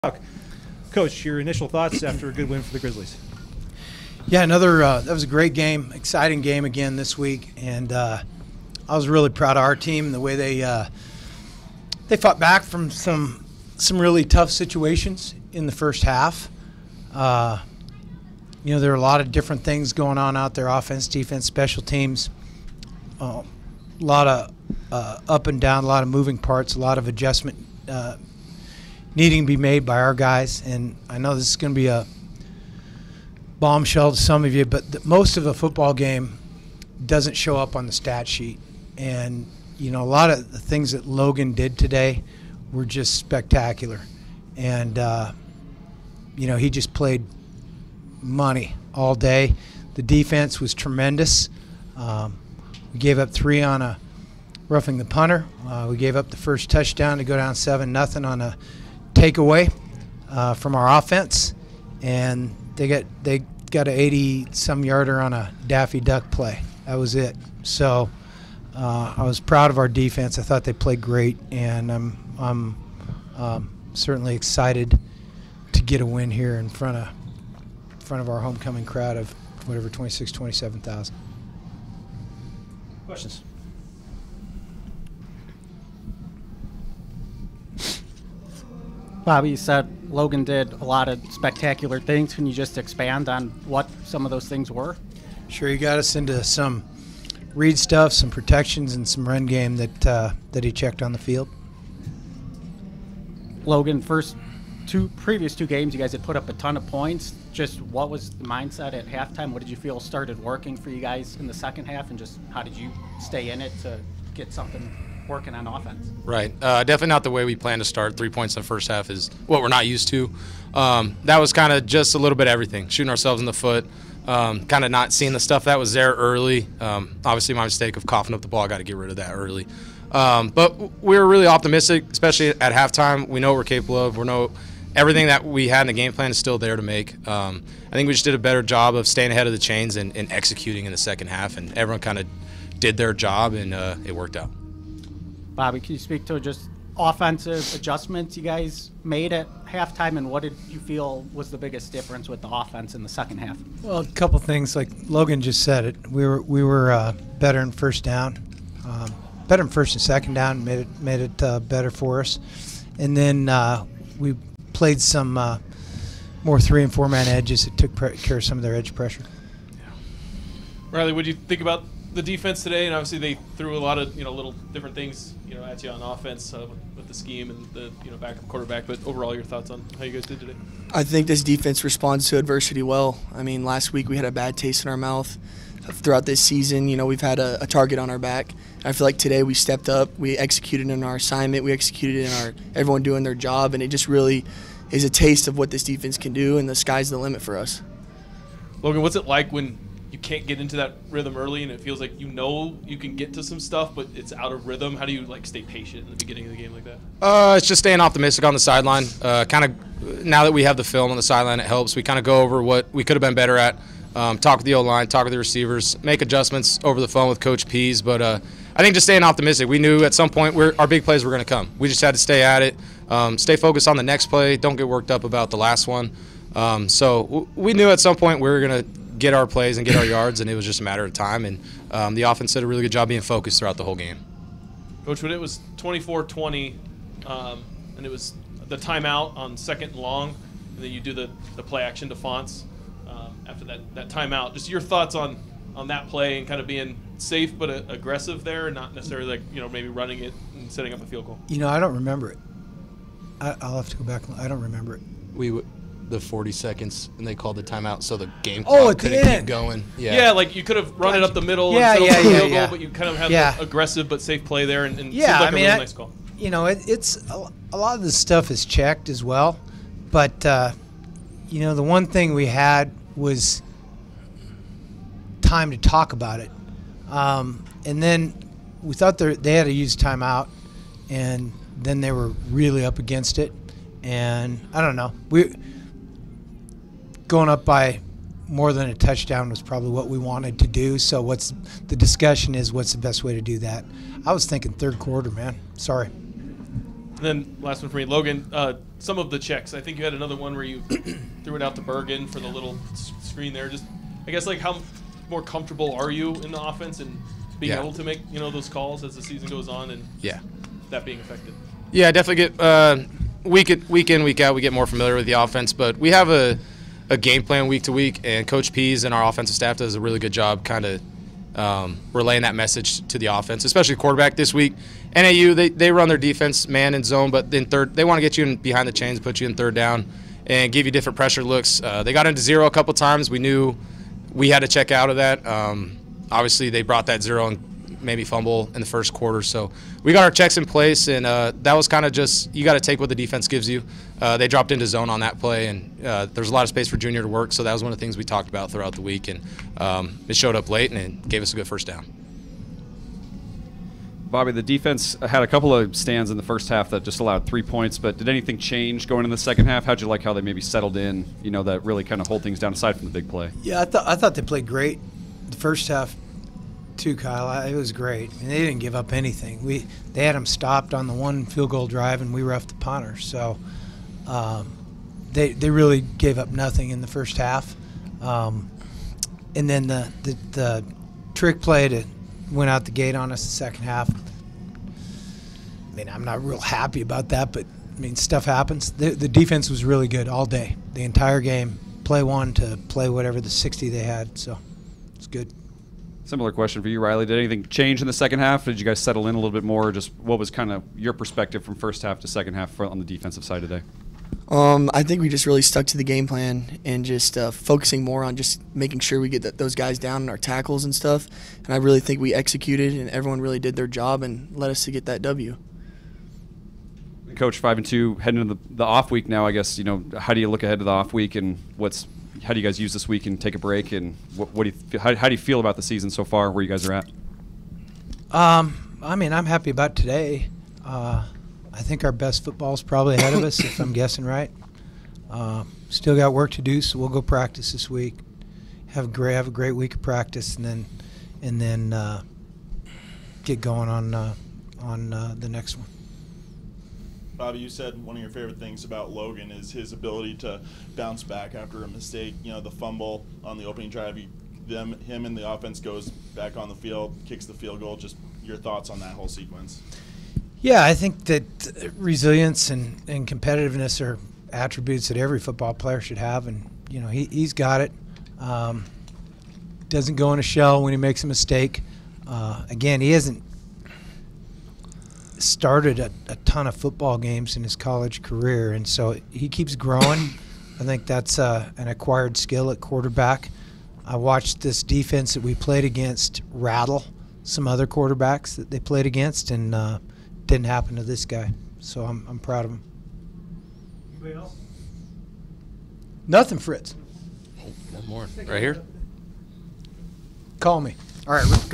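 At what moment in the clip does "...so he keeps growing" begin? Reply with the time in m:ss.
7:58.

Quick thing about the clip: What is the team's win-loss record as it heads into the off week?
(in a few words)
5-2.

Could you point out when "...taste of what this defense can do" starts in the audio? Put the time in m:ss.
3:15.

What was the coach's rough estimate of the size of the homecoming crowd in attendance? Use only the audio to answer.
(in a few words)
26,000-27,000.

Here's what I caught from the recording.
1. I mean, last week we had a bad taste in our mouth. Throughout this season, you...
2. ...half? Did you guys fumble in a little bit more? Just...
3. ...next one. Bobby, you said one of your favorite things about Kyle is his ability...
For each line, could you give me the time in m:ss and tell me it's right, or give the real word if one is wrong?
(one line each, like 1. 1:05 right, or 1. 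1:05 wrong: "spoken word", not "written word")
1. 3:03 right
2. 6:38 wrong: "settle", not "fumble"
3. 7:25 wrong: "Logan", not "Kyle".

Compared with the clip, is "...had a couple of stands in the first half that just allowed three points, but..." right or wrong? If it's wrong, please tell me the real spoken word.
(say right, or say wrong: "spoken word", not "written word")
right.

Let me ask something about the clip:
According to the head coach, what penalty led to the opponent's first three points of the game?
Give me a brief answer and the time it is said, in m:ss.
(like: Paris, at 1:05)
Roughing the punter, at 0:54.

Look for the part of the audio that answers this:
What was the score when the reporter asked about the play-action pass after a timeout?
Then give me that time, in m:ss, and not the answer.
3:55.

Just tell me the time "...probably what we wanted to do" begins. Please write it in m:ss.
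4:49.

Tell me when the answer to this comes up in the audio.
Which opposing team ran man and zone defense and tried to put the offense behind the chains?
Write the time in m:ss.
5:25.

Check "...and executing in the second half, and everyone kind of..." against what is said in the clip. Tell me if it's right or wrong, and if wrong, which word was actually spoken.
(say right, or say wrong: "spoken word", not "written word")
right.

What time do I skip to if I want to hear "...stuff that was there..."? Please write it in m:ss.
2:05.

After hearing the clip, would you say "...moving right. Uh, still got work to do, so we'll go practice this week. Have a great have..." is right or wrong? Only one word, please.
wrong.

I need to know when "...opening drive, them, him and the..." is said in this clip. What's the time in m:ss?
7:33.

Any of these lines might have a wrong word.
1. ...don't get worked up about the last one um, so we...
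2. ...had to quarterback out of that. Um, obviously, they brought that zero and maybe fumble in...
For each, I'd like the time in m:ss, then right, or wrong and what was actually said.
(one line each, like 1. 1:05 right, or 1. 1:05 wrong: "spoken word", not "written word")
1. 3:44 right
2. 5:34 wrong: "check", not "quarterback".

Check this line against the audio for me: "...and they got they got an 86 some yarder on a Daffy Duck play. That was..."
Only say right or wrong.
wrong.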